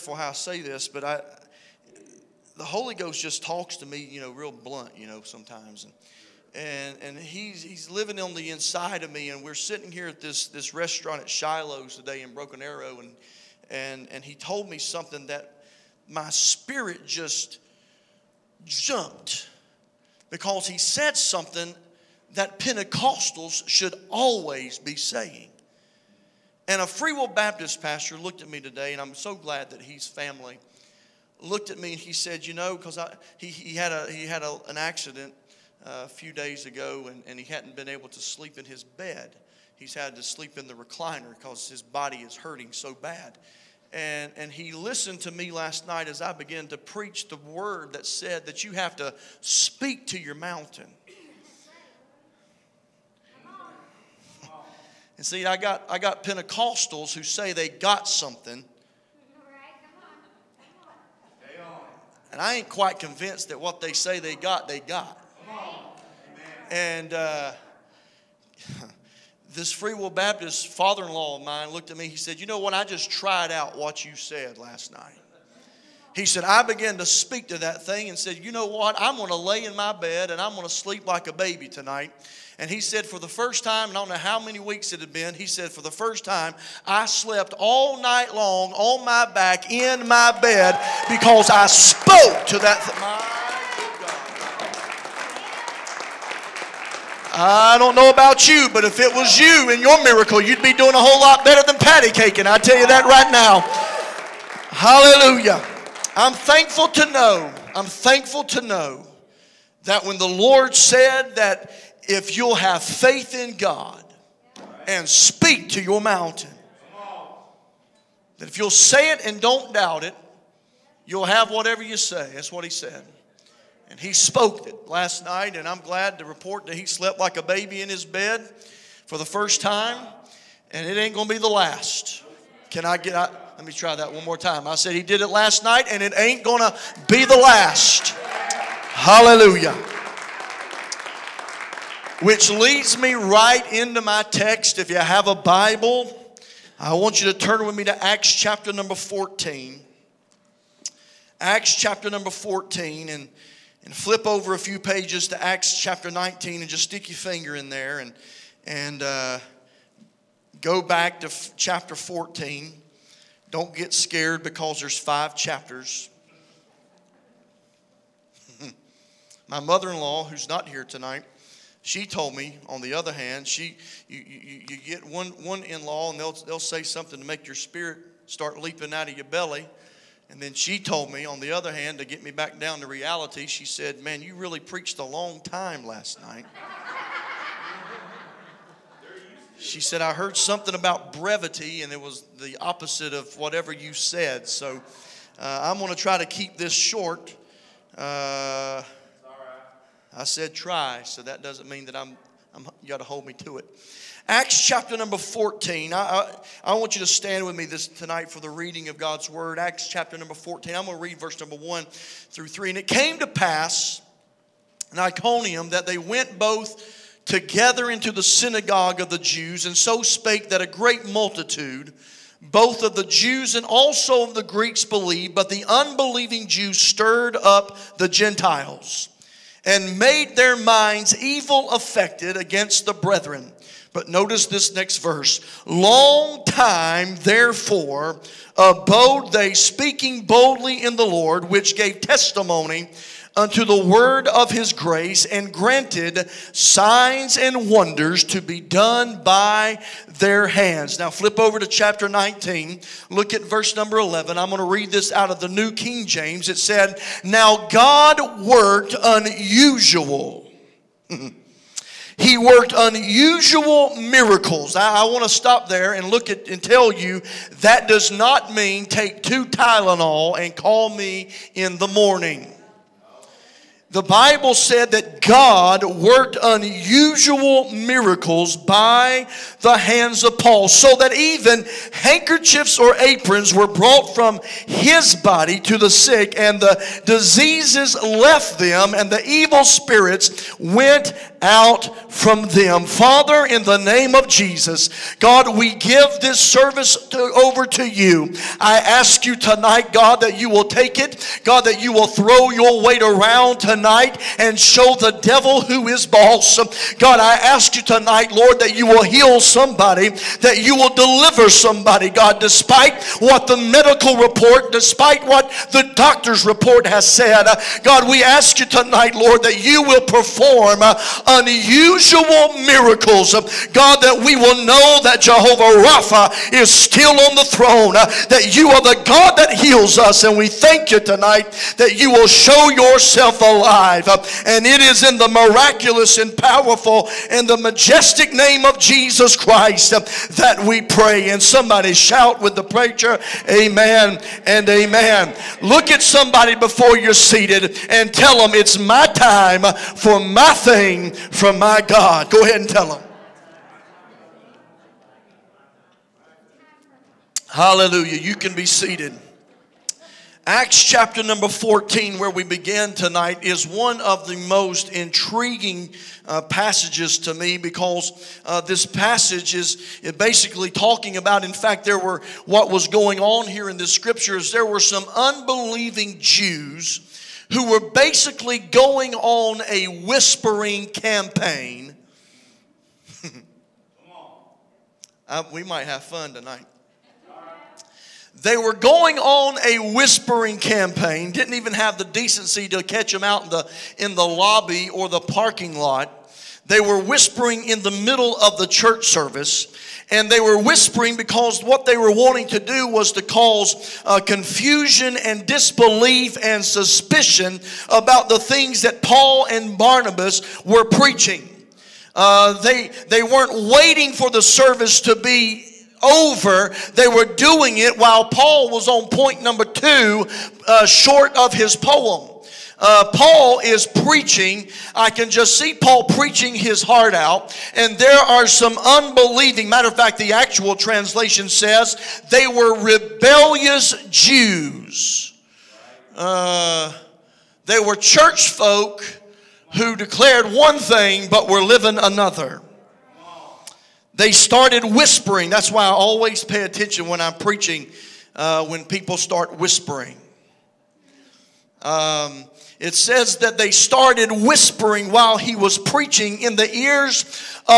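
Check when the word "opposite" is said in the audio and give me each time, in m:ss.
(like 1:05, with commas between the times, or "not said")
3:12.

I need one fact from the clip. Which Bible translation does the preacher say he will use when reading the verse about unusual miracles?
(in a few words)
New King James.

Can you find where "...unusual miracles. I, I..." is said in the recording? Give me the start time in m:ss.
4:22.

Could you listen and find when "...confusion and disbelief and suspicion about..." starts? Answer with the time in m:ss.
6:44.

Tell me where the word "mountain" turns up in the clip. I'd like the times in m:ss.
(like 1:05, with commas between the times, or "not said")
0:50, 1:55.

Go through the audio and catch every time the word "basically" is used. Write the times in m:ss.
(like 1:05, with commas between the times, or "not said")
6:10, 6:17.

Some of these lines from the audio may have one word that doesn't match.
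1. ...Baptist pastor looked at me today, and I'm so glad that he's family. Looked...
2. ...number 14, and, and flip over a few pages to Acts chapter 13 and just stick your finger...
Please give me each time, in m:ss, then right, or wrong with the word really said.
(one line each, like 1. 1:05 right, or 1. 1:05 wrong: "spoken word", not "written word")
1. 0:27 right
2. 2:32 wrong: "19", not "13".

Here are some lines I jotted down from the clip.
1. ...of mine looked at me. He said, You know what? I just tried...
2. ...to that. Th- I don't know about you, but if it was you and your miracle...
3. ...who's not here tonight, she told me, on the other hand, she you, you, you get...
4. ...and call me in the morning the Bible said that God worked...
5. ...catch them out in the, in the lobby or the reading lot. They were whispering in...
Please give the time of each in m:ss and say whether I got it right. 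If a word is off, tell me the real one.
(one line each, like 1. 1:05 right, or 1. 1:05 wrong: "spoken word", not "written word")
1. 1:11 right
2. 1:32 right
3. 2:50 right
4. 4:30 right
5. 6:32 wrong: "parking", not "reading".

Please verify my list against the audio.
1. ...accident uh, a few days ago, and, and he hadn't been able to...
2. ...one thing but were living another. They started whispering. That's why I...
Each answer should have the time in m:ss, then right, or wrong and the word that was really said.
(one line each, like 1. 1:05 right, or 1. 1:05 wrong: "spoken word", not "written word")
1. 0:34 right
2. 7:20 right.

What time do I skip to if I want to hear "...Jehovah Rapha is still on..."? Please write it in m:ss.
5:25.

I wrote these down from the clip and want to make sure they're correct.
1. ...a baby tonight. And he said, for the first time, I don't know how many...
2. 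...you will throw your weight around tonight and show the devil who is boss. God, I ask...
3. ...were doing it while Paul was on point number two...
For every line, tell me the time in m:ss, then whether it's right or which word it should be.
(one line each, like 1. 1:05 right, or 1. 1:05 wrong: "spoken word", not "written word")
1. 1:21 right
2. 5:01 right
3. 6:57 right.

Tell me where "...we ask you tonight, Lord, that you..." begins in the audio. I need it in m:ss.
5:18.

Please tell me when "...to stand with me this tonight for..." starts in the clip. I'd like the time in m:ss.
3:26.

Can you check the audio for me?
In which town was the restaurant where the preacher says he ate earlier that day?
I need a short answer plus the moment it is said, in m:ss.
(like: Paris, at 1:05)
Broken Arrow, at 0:12.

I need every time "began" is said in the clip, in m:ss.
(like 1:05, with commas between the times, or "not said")
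0:46, 1:16.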